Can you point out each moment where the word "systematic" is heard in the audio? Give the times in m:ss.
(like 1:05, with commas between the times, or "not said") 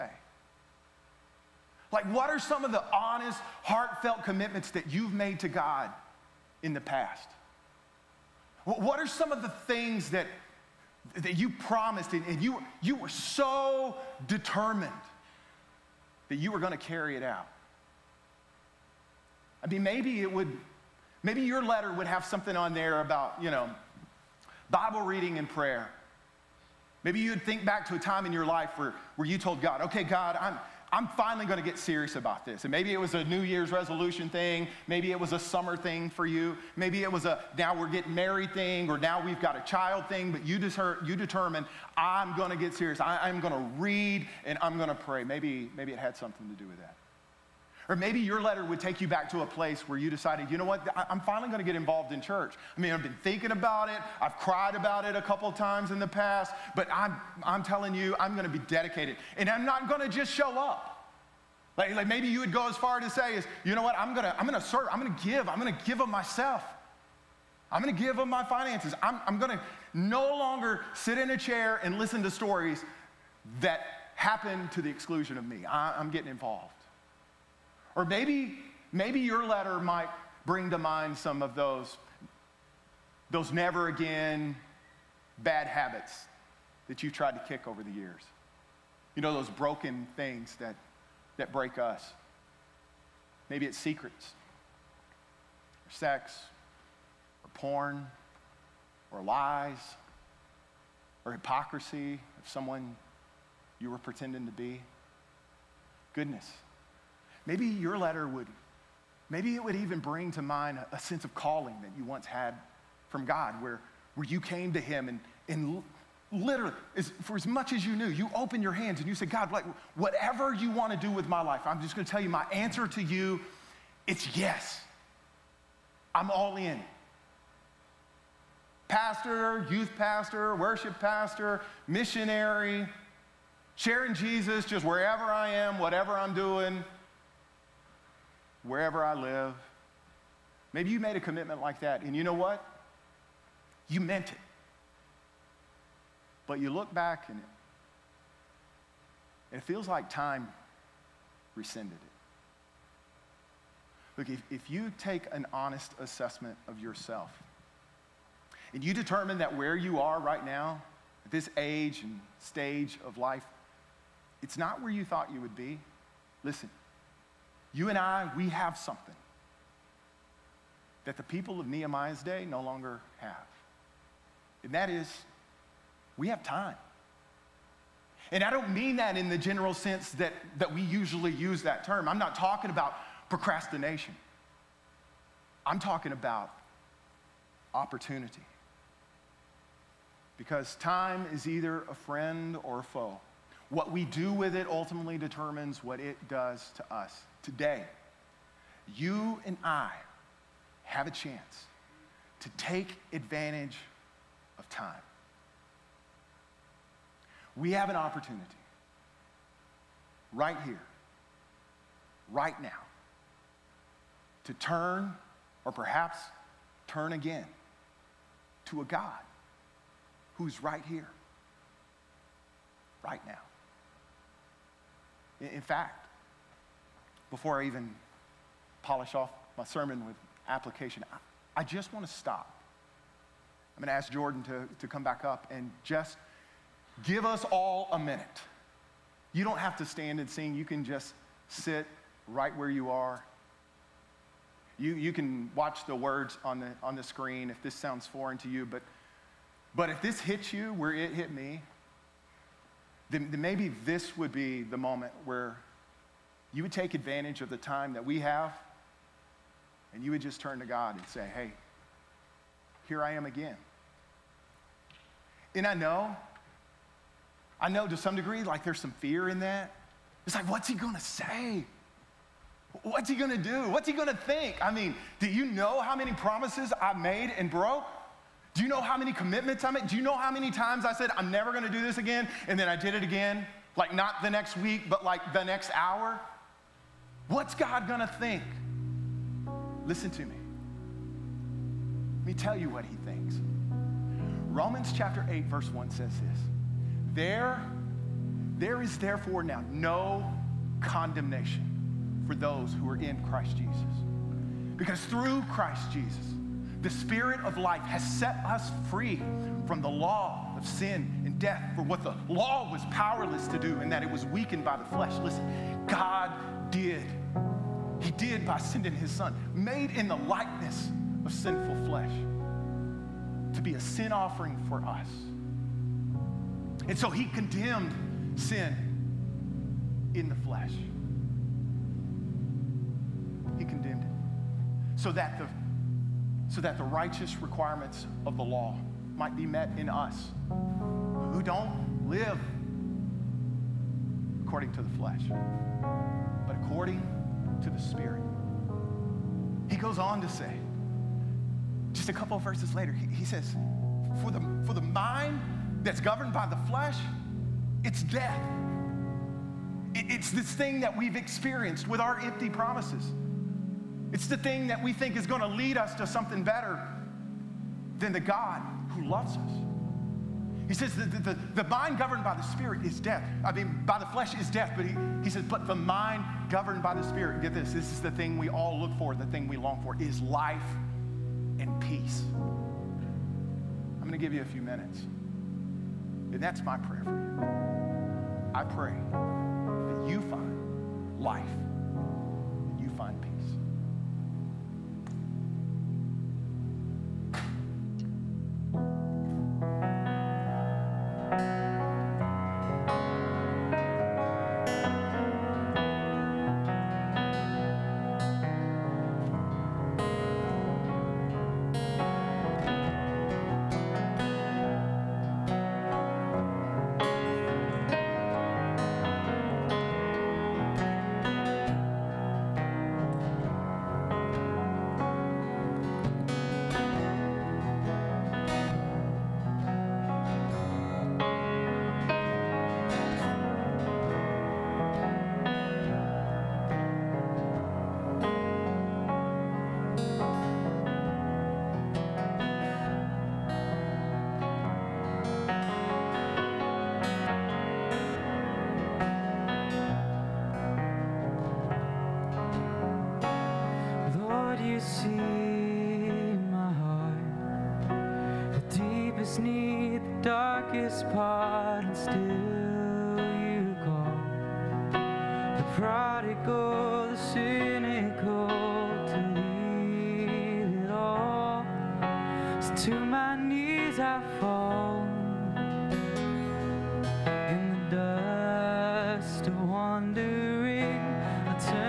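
not said.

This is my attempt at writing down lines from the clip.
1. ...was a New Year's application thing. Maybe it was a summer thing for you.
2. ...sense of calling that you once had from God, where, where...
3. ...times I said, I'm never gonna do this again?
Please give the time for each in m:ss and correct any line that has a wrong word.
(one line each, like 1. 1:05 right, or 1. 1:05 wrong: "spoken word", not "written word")
1. 0:32 wrong: "resolution", not "application"
2. 1:50 right
3. 4:40 right.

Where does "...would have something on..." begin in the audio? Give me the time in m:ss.
0:21.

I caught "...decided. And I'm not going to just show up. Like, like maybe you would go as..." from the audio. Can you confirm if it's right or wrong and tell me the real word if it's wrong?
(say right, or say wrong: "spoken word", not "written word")
wrong: "dedicated", not "decided".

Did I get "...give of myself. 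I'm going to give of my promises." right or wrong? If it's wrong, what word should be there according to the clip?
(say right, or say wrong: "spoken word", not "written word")
wrong: "finances", not "promises".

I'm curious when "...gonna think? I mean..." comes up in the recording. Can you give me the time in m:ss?
4:33.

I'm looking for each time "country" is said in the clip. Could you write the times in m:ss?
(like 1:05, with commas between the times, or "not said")
not said.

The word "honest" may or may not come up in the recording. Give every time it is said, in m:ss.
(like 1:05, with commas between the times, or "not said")
0:02, 2:35.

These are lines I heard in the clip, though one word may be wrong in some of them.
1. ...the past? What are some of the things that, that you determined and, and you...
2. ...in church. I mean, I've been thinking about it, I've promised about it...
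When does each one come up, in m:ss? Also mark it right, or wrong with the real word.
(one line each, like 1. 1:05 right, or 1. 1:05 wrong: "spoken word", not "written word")
1. 0:06 wrong: "promised", not "determined"
2. 0:52 wrong: "cried", not "promised".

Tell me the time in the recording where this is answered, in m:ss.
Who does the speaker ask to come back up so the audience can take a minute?
3:54.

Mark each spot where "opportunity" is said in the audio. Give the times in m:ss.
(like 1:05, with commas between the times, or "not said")
3:07, 3:27.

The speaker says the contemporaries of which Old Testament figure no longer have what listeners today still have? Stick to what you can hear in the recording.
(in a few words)
Nehemiah.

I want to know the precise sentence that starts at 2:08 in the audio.
Pastor, youth pastor, worship pastor, missionary, sharing Jesus just wherever I am, whatever I'm doing wherever I live.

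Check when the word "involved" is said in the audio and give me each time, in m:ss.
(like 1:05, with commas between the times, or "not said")
0:51, 1:16.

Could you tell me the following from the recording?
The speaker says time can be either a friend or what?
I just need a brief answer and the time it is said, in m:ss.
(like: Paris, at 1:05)
a foe, at 3:12.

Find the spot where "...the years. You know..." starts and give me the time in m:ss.
1:27.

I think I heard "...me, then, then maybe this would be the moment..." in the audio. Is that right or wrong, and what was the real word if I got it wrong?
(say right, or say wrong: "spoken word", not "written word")
right.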